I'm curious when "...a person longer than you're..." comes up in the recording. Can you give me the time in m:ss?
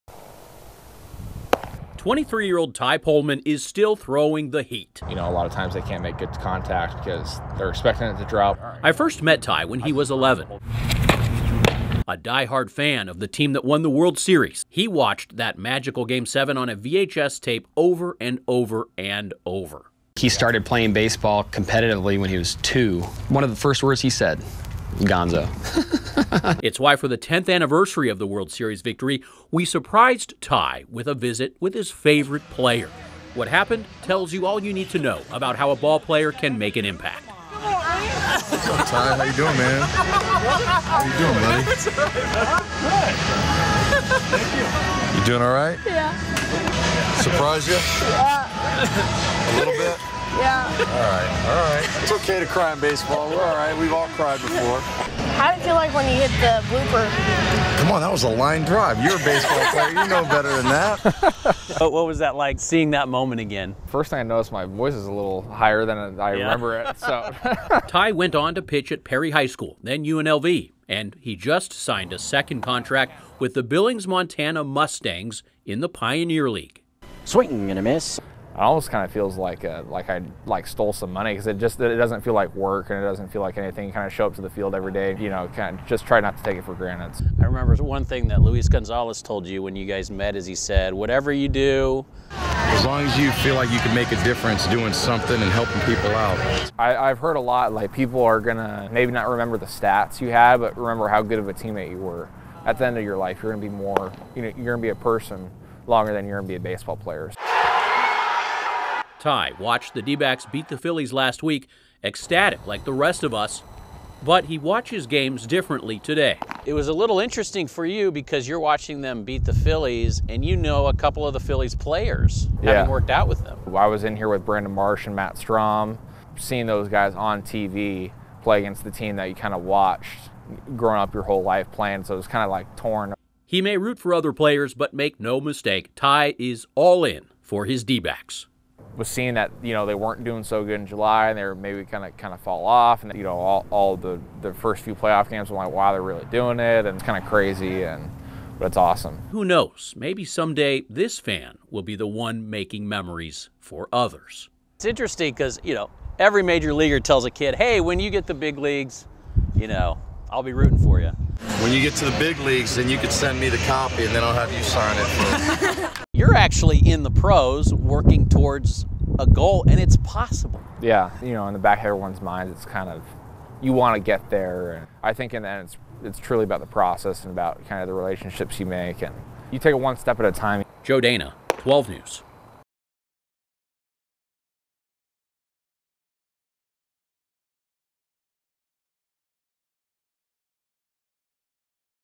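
1:44.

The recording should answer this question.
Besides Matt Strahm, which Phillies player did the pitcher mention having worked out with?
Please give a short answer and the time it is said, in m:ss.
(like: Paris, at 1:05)
Brandon Marsh, at 2:04.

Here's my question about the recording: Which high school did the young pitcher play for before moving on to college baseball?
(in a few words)
Perry High School.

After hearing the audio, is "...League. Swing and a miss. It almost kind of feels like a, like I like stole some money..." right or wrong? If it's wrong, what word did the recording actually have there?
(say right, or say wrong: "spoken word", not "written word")
right.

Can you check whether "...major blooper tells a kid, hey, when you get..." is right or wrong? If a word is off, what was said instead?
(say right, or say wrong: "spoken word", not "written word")
wrong: "leaguer", not "blooper".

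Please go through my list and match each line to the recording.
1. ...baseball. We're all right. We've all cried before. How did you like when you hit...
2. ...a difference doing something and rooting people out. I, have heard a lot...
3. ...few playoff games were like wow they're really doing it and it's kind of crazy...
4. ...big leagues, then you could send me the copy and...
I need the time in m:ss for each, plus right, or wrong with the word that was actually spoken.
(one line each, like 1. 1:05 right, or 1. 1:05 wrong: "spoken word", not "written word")
1. 0:52 right
2. 1:34 wrong: "helping", not "rooting"
3. 2:24 right
4. 2:42 right.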